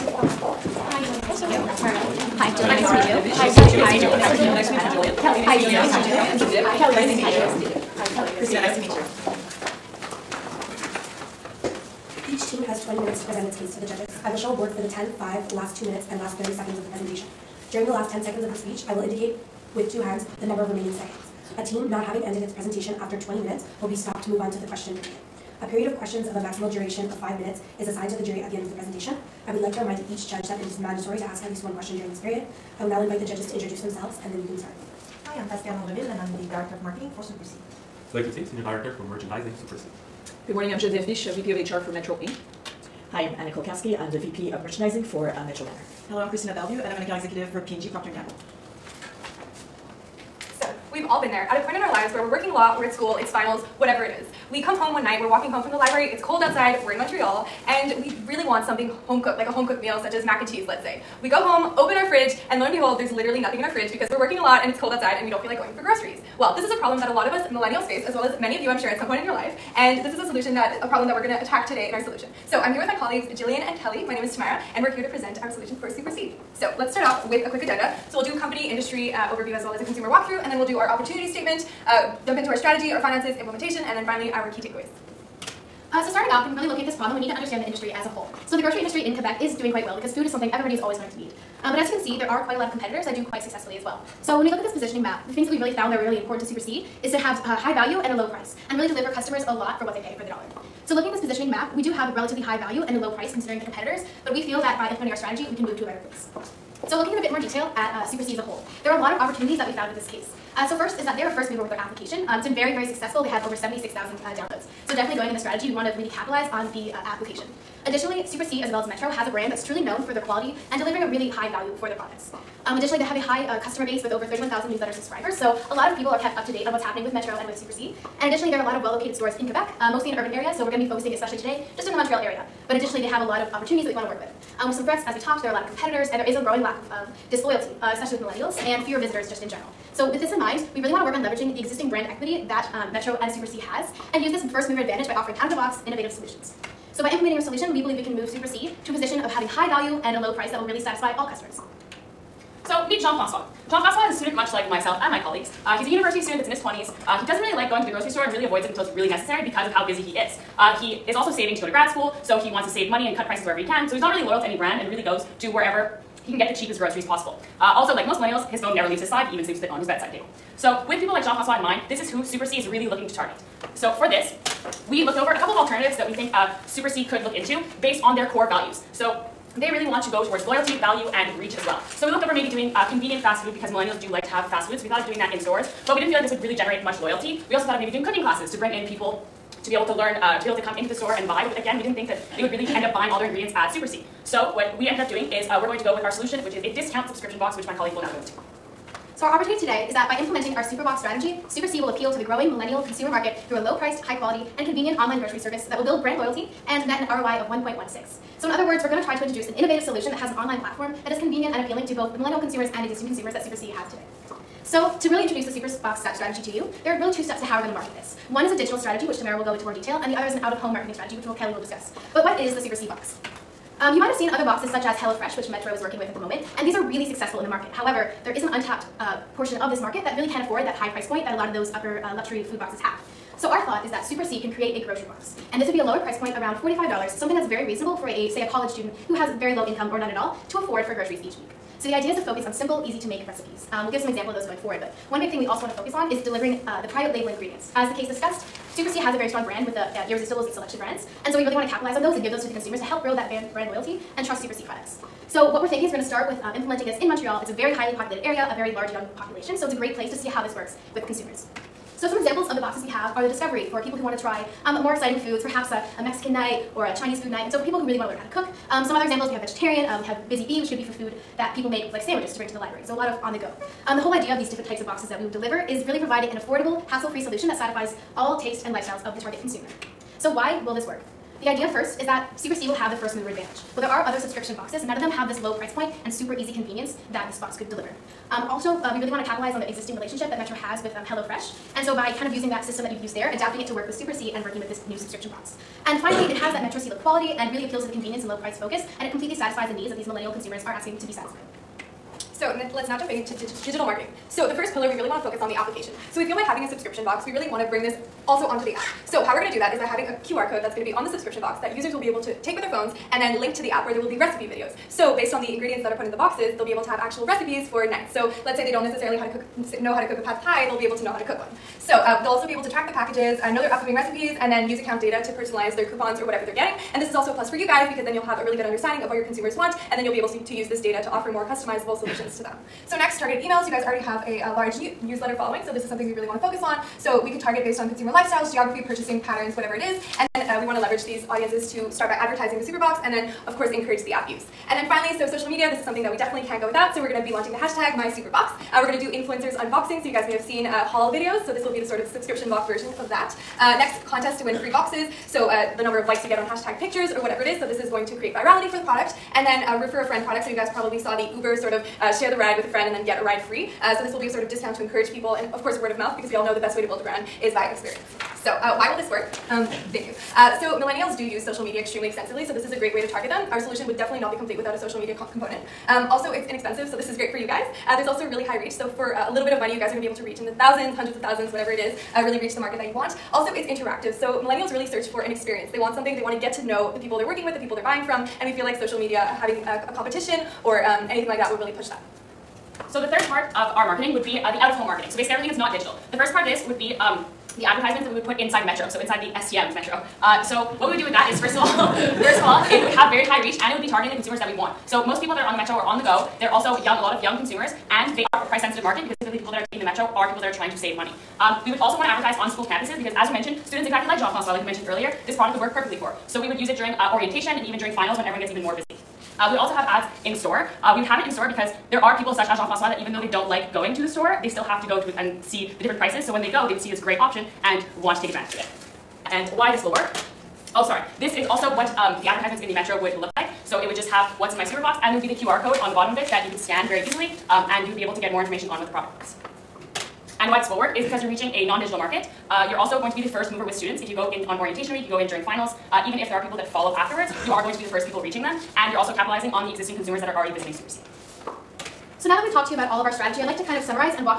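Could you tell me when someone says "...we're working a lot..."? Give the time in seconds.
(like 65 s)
64 s.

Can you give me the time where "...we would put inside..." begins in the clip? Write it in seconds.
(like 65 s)
398 s.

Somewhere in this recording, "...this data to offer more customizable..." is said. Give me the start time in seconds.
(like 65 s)
330 s.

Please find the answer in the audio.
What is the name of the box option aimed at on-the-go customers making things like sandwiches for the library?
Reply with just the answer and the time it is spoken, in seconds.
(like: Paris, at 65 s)
Busy Bee, at 270 s.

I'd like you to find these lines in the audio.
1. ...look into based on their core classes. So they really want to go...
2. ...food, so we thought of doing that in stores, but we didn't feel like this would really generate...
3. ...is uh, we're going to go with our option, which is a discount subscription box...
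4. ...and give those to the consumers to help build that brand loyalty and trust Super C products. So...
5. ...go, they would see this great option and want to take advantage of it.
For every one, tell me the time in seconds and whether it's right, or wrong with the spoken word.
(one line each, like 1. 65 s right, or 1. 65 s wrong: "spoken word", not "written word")
1. 177 s wrong: "values", not "classes"
2. 184 s right
3. 195 s wrong: "solution", not "option"
4. 252 s right
5. 426 s right.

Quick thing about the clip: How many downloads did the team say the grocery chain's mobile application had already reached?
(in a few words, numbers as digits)
76,000.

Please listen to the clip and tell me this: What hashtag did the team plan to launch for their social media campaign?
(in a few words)
MySuperBox.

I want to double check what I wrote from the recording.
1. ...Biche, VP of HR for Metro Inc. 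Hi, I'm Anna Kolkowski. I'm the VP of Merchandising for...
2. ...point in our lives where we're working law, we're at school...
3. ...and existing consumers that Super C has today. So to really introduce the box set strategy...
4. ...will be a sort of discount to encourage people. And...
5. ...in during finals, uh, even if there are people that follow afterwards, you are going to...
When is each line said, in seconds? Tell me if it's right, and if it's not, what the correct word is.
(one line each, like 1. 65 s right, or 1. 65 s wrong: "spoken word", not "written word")
1. 41 s right
2. 51 s right
3. 212 s right
4. 364 s right
5. 445 s right.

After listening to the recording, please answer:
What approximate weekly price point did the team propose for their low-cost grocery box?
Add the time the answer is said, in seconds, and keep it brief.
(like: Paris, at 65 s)
$45, at 236 s.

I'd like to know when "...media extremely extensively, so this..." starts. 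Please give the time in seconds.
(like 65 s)
371 s.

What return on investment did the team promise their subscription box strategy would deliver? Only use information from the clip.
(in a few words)
1.16.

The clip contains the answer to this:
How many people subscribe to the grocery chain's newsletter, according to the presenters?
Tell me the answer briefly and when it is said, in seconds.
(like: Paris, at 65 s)
31,000, at 124 s.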